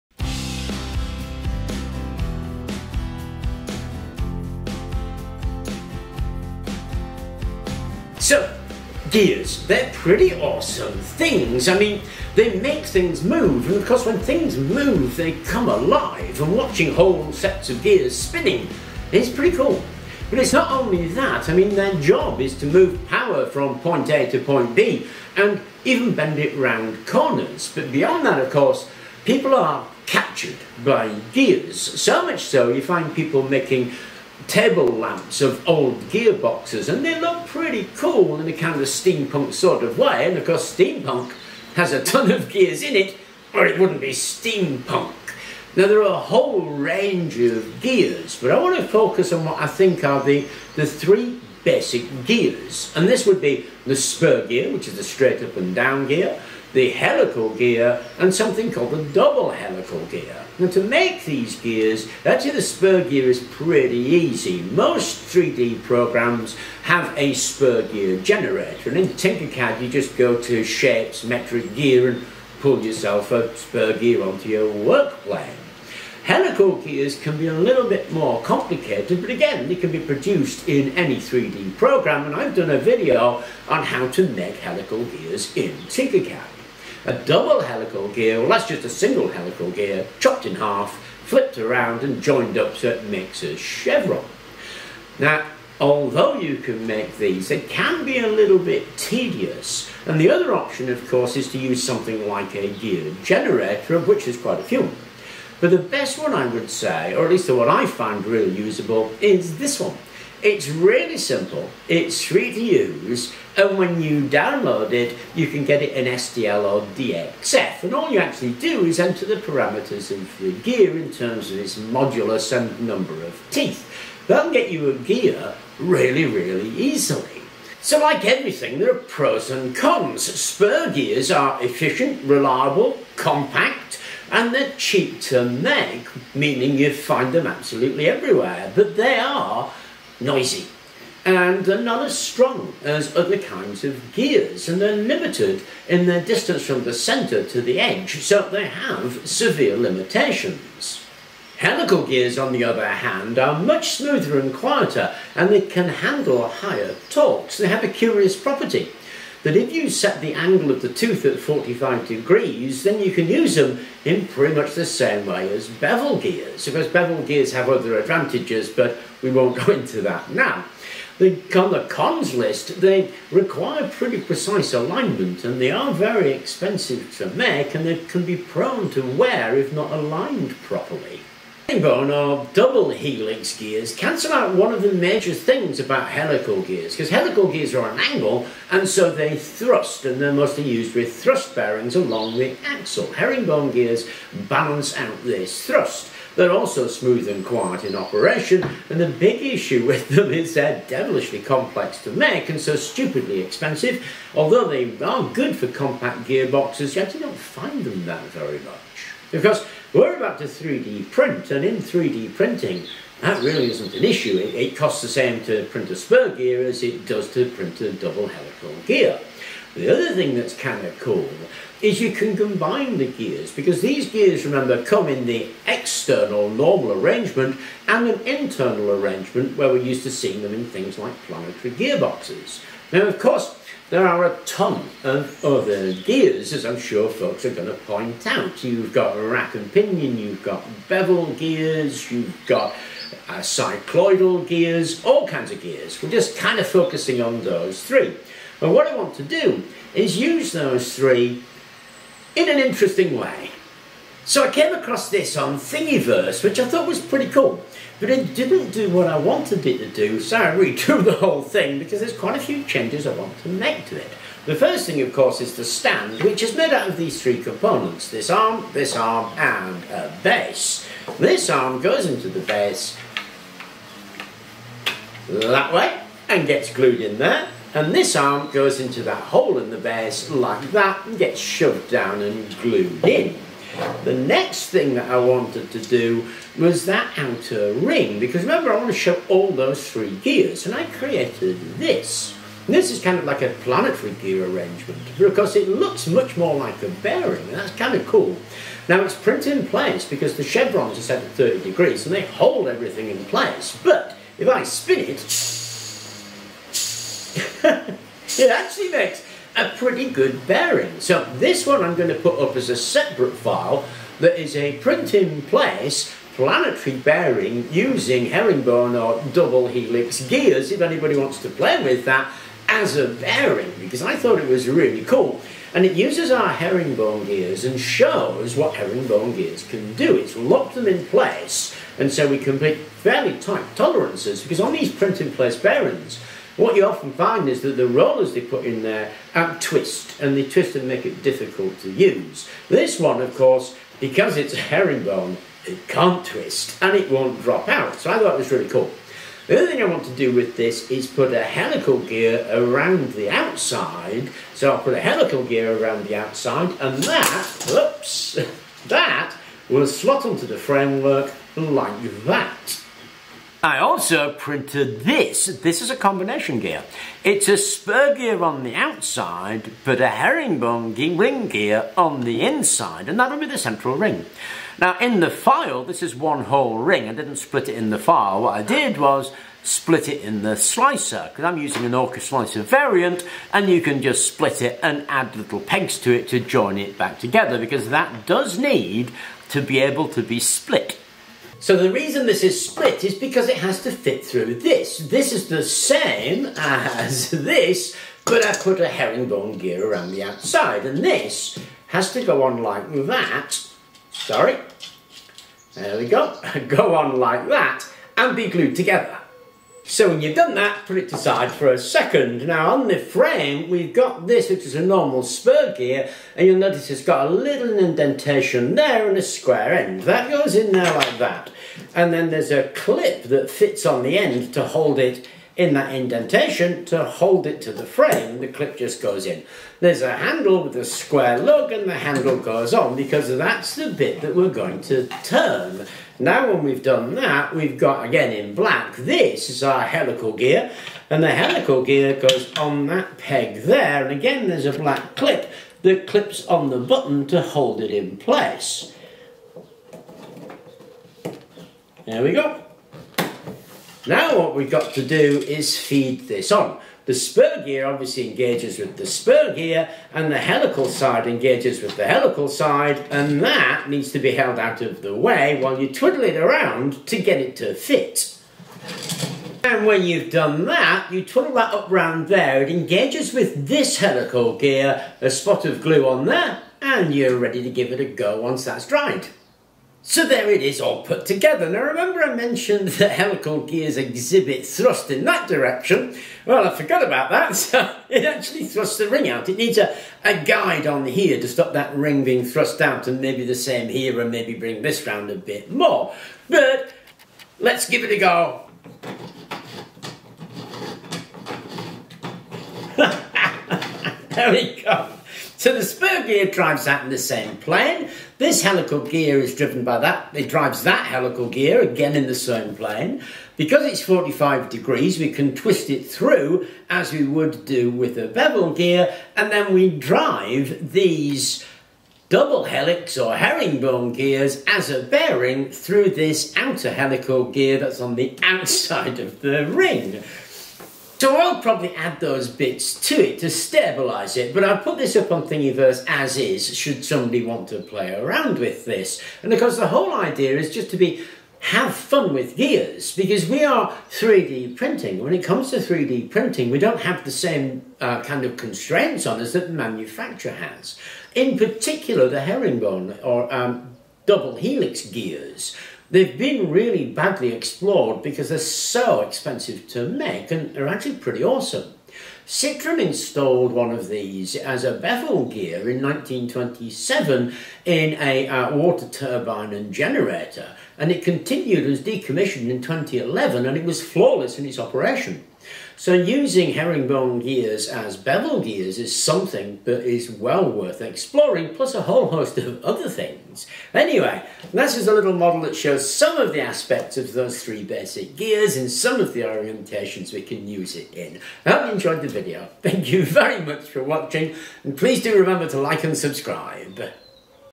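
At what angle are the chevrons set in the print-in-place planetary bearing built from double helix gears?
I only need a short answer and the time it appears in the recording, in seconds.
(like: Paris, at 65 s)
30 degrees, at 301 s.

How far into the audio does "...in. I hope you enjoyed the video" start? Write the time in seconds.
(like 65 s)
591 s.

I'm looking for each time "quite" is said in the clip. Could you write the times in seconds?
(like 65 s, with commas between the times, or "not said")
104 s, 262 s.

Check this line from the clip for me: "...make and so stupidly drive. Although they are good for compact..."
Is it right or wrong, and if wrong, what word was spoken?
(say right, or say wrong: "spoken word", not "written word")
wrong: "expensive", not "drive".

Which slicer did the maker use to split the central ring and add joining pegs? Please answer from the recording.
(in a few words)
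Orca slicer.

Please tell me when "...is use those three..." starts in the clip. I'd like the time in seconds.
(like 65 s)
249 s.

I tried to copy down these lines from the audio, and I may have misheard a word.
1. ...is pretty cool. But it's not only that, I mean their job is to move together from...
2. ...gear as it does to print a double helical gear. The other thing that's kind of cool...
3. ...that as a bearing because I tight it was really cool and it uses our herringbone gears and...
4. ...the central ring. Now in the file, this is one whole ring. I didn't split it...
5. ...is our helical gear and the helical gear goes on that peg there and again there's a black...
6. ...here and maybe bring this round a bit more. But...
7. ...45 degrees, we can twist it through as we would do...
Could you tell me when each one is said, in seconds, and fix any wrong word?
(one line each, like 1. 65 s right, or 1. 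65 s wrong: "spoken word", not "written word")
1. 19 s wrong: "power", not "together"
2. 216 s right
3. 322 s wrong: "thought", not "tight"
4. 373 s right
5. 439 s right
6. 493 s right
7. 514 s right.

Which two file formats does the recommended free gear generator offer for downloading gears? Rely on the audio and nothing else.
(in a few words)
STL or DXF.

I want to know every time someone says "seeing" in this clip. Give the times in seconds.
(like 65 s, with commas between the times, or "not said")
230 s.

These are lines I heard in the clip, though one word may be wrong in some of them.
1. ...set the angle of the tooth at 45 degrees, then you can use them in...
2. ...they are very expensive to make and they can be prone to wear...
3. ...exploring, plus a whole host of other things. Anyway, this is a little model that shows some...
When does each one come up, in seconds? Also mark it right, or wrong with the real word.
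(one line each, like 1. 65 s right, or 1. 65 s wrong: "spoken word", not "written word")
1. 159 s right
2. 175 s right
3. 580 s right.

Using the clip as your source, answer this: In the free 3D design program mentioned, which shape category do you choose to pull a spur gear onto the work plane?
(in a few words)
Metric gear.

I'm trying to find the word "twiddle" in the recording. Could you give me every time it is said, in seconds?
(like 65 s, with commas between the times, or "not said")
465 s, 471 s.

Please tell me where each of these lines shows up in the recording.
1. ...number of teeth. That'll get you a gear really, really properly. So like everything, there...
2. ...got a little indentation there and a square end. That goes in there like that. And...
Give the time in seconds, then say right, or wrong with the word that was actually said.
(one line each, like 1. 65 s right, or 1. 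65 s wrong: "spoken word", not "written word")
1. 122 s wrong: "easily", not "properly"
2. 417 s right.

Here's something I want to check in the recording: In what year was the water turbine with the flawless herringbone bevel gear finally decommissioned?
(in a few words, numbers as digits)
2011.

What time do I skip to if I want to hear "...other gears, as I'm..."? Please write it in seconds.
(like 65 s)
235 s.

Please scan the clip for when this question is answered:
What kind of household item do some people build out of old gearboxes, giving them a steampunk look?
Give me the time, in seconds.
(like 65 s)
34 s.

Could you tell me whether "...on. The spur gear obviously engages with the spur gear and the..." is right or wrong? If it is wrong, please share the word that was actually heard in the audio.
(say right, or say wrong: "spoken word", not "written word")
right.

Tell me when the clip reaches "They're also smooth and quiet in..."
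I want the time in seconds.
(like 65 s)
196 s.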